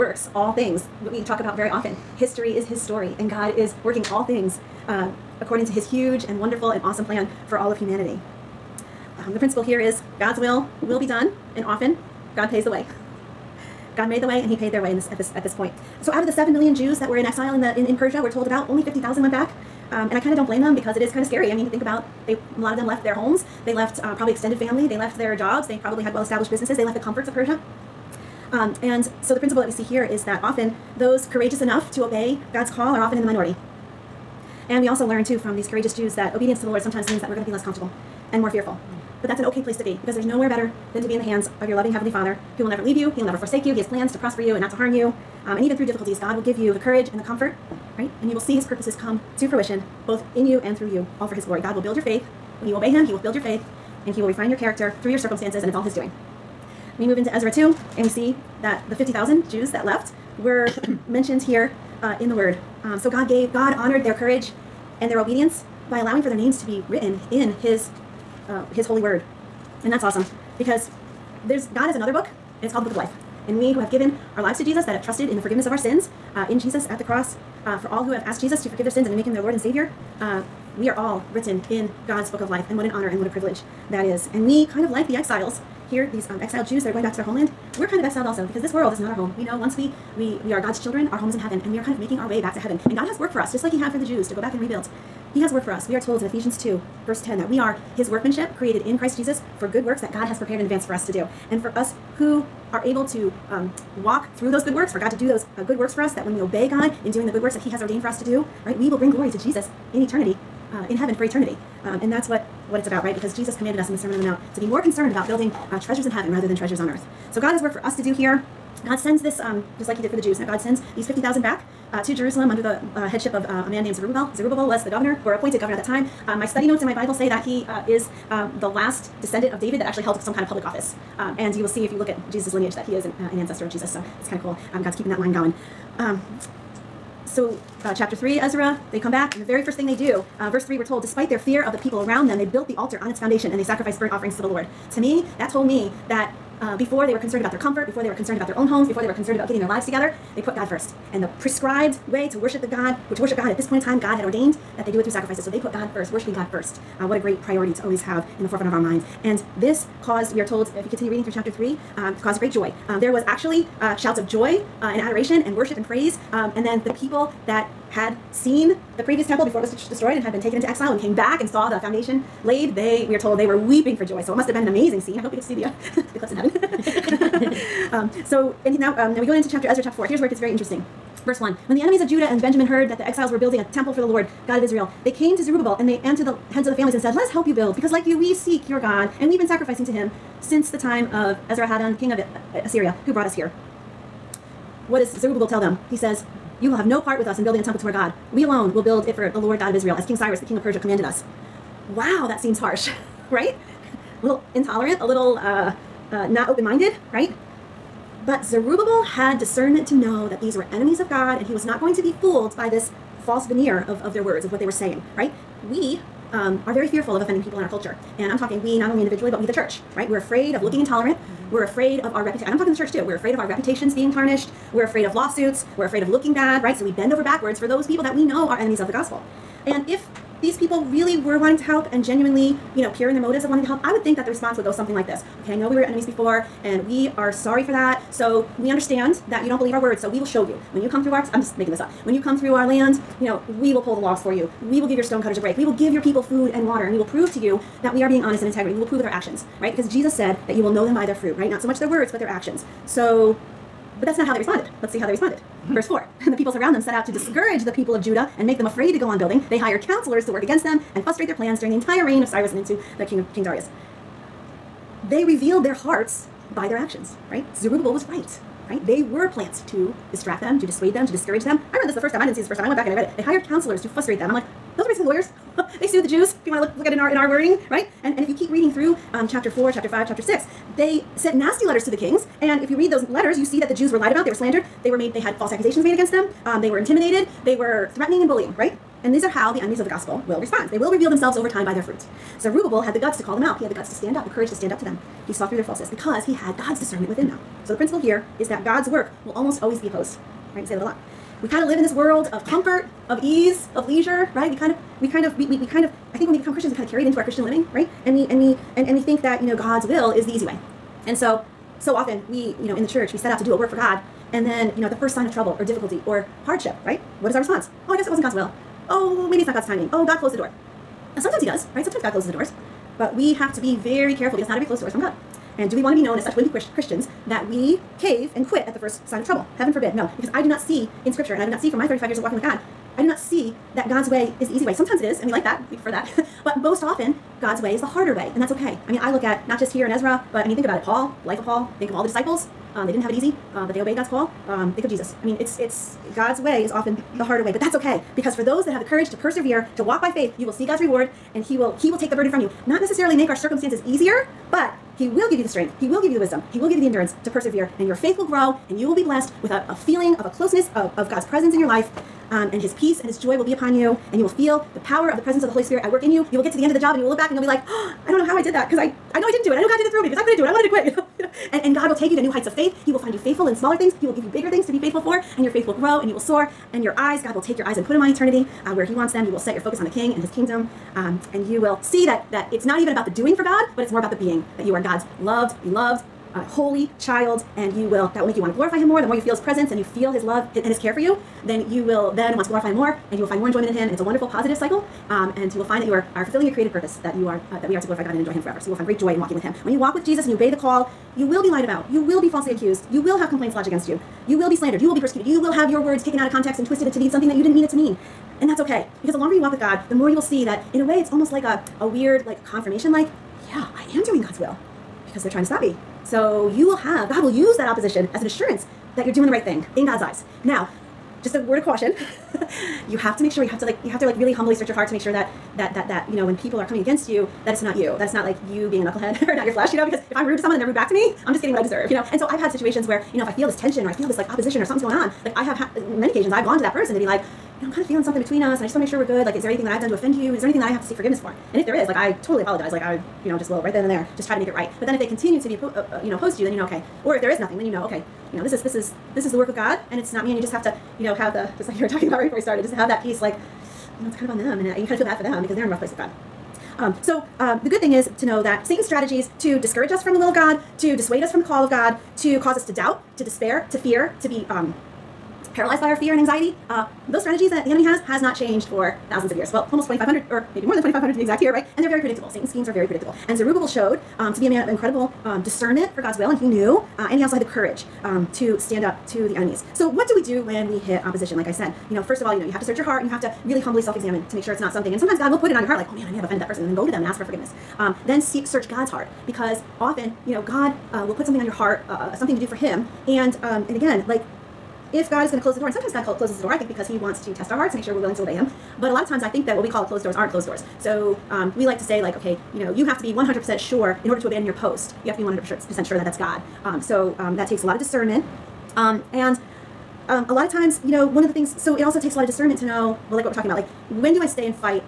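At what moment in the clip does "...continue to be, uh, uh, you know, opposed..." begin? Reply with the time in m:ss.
7:25.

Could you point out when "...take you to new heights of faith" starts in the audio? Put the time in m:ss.
6:11.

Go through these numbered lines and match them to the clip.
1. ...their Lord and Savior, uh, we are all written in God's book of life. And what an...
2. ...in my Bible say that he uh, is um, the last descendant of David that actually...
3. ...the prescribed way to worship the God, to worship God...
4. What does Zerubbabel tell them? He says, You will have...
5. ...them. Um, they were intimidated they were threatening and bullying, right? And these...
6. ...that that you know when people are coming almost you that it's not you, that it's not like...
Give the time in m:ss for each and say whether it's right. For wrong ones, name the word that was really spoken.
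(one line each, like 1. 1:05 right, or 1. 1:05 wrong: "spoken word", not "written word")
1. 1:19 right
2. 2:06 right
3. 2:31 right
4. 3:14 right
5. 4:46 right
6. 7:05 wrong: "against", not "almost".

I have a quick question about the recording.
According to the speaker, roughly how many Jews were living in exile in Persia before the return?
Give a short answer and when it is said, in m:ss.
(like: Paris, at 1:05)
7 million, at 0:16.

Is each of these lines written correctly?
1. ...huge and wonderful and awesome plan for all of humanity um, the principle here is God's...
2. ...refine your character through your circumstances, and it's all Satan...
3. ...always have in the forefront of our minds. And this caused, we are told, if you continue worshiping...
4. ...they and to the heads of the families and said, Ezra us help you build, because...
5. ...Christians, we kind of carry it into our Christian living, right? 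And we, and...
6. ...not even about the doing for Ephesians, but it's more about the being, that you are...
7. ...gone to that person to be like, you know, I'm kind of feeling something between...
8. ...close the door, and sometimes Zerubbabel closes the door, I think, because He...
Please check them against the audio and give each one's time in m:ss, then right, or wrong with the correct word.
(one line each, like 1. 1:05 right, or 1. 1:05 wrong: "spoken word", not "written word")
1. 0:05 right
2. 0:54 wrong: "His", not "Satan"
3. 2:37 wrong: "reading", not "worshiping"
4. 3:05 wrong: "Let", not "Ezra"
5. 5:06 right
6. 6:22 wrong: "God", not "Ephesians"
7. 7:16 right
8. 8:15 wrong: "God", not "Zerubbabel".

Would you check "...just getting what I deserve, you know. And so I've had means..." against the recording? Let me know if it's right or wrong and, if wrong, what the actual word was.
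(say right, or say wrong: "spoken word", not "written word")
wrong: "situations", not "means".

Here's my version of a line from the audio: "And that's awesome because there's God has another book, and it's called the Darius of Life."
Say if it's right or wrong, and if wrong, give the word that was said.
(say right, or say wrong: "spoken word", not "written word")
wrong: "Book", not "Darius".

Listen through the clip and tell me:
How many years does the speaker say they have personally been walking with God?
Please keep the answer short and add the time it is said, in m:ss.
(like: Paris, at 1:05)
35 years, at 5:31.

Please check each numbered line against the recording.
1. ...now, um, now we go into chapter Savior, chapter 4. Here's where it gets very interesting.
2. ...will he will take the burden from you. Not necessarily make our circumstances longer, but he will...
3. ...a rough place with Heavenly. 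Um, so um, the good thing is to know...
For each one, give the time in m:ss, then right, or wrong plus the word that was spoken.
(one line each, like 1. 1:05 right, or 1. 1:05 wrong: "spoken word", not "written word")
1. 2:58 wrong: "Ezra", not "Savior"
2. 5:51 wrong: "easier", not "longer"
3. 7:35 wrong: "God", not "Heavenly".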